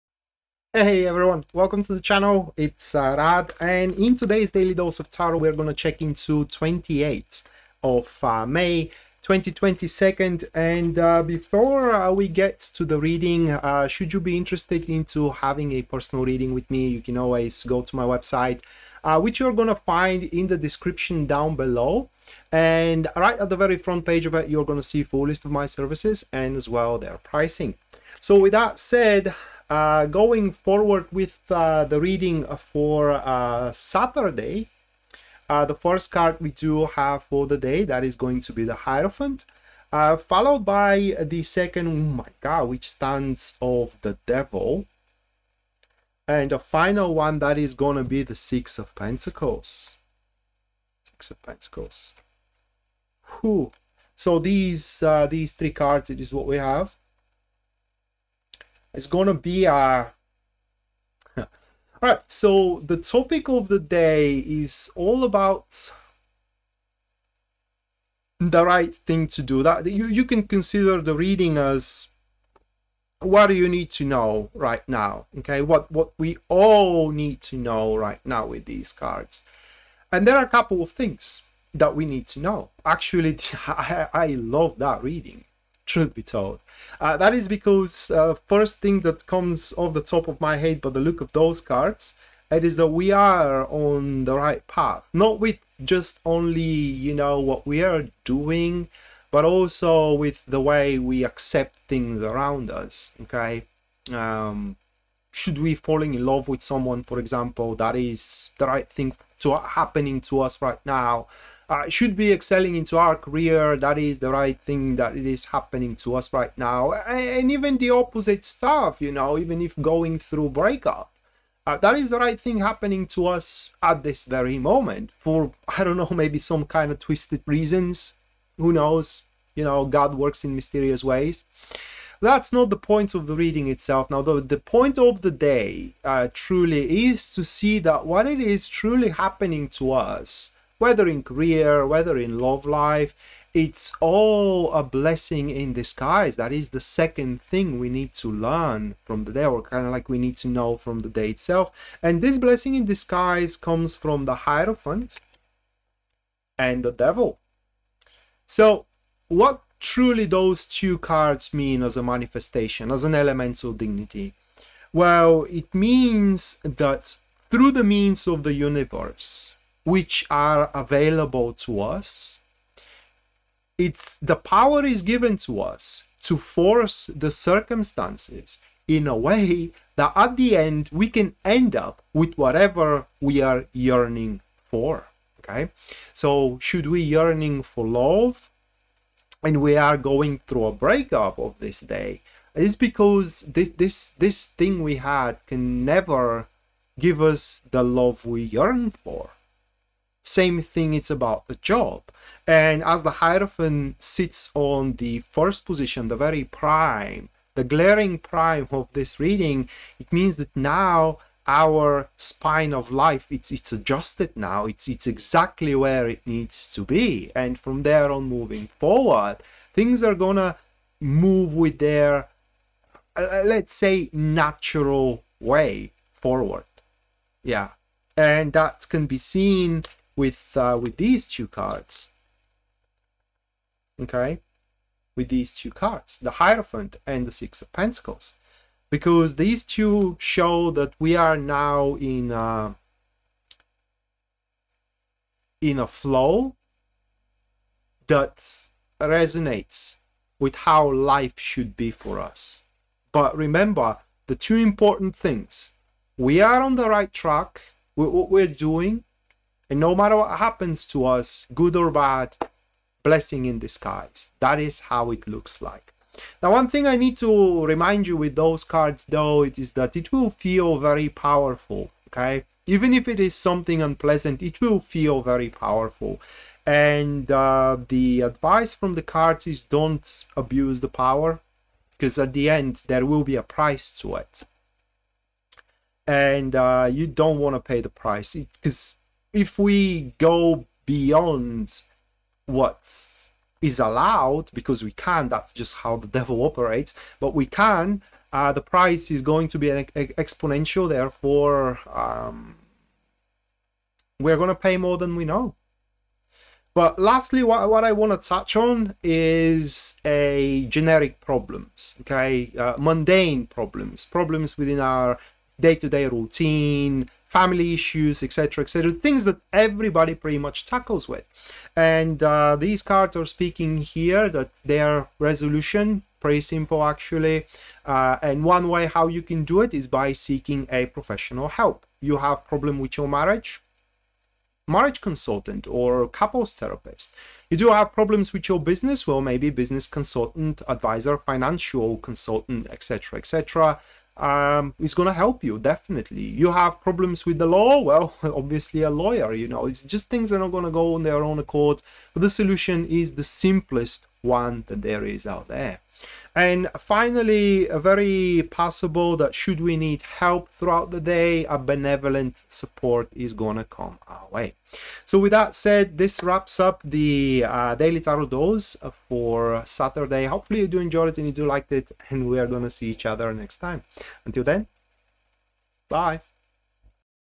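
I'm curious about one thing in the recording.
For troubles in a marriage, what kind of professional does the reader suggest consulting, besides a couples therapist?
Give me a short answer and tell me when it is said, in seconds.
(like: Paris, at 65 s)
Marriage consultant, at 334 s.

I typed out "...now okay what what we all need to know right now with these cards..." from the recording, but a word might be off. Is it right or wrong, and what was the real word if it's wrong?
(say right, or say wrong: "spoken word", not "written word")
right.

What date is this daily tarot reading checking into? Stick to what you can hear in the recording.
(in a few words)
28th of May 2022.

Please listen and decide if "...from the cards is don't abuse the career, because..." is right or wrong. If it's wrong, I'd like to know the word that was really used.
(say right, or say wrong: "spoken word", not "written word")
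wrong: "power", not "career".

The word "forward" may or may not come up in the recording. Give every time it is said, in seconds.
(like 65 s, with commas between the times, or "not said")
30 s, 218 s, 226 s.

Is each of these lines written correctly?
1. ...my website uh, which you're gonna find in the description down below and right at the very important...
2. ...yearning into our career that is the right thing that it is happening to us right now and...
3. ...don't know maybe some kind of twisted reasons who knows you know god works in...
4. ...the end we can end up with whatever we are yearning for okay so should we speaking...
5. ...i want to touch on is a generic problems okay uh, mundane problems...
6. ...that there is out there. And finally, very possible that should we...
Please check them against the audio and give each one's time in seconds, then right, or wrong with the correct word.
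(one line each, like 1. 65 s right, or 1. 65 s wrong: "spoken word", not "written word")
1. 17 s wrong: "front", not "important"
2. 112 s wrong: "excelling", not "yearning"
3. 125 s right
4. 180 s wrong: "yearning", not "speaking"
5. 307 s right
6. 354 s right.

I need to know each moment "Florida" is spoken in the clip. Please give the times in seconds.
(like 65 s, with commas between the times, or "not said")
not said.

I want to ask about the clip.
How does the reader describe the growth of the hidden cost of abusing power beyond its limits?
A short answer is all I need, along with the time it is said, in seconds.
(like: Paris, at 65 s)
Exponential, at 299 s.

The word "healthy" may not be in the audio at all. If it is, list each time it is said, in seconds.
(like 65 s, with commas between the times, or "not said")
not said.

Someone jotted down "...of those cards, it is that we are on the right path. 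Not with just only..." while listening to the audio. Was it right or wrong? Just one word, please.
right.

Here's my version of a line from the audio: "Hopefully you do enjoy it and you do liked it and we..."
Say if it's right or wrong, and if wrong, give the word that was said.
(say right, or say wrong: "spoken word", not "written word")
right.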